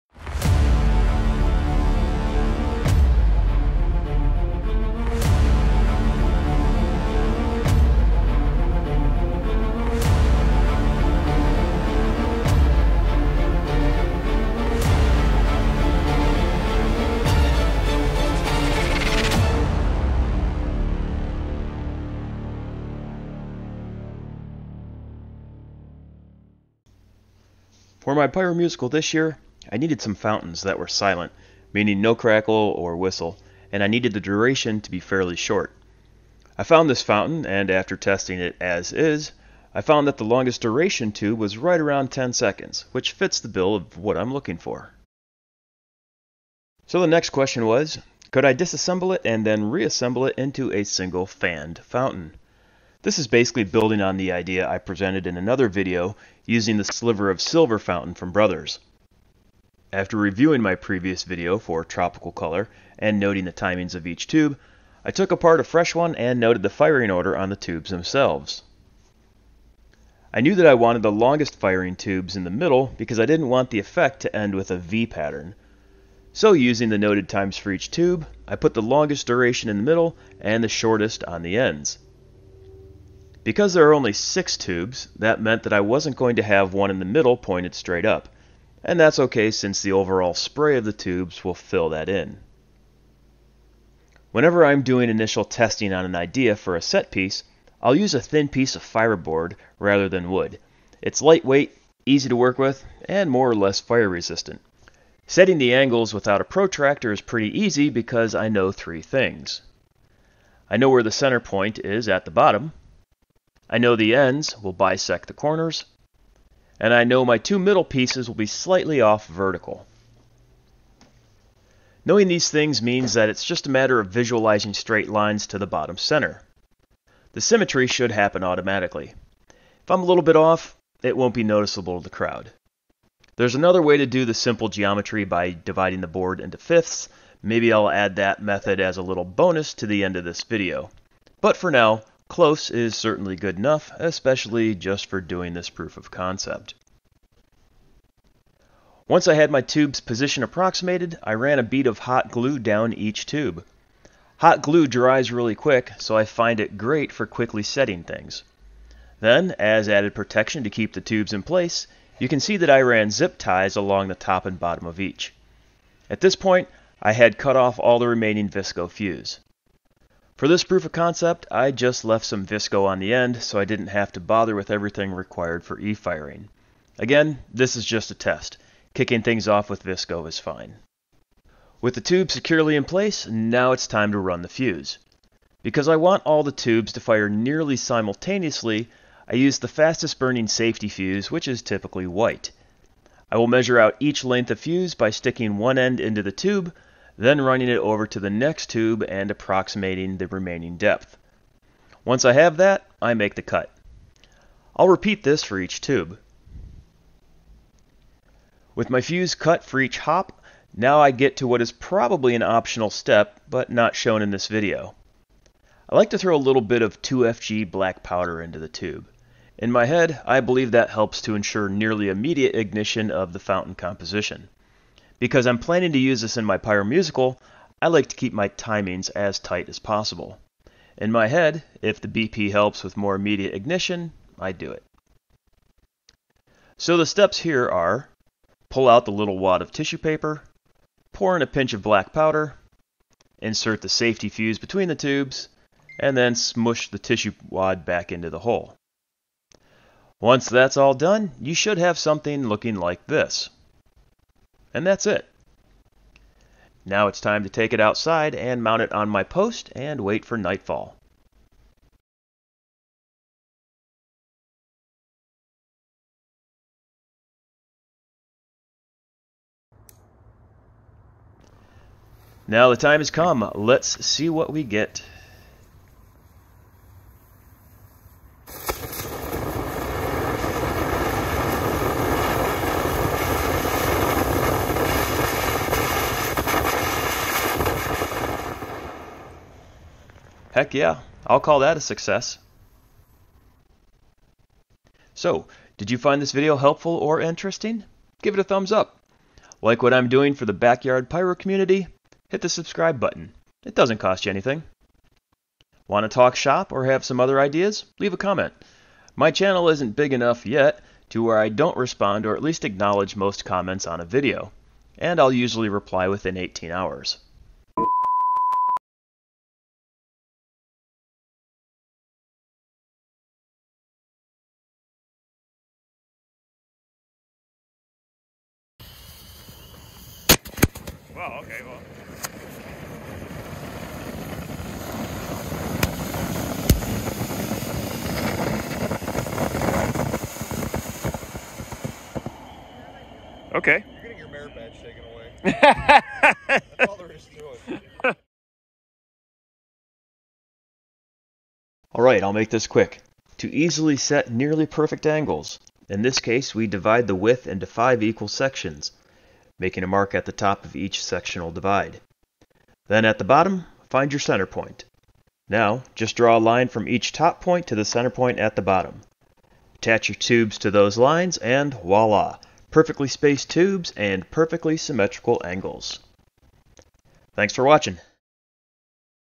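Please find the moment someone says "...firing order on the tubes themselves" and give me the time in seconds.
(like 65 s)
66 s.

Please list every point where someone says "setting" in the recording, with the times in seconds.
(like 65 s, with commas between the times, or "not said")
105 s, 157 s.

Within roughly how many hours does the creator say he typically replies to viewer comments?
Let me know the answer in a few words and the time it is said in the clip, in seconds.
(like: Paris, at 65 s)
18 hours, at 316 s.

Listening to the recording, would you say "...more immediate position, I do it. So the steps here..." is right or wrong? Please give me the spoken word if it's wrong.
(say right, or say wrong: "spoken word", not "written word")
wrong: "ignition", not "position".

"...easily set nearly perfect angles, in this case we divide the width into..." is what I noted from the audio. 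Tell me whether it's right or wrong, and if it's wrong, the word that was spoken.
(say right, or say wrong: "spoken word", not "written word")
right.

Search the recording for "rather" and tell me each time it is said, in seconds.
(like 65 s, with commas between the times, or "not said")
99 s.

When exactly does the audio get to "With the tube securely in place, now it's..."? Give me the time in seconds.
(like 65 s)
181 s.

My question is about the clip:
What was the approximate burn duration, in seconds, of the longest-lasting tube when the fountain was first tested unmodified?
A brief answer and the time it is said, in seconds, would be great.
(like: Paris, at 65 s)
10 seconds, at 42 s.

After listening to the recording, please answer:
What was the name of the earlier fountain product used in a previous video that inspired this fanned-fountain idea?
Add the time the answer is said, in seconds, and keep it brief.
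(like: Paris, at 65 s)
Sliver of Silver, at 56 s.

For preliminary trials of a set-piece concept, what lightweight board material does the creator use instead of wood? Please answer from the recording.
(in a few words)
Fiberboard.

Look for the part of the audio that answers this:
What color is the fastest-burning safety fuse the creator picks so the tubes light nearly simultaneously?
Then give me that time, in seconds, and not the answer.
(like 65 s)
192 s.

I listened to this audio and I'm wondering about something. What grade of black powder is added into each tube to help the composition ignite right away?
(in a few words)
2FG.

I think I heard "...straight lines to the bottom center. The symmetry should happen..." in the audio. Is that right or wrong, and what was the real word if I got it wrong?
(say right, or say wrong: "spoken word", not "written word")
right.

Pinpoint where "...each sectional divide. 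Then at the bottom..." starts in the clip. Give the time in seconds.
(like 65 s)
360 s.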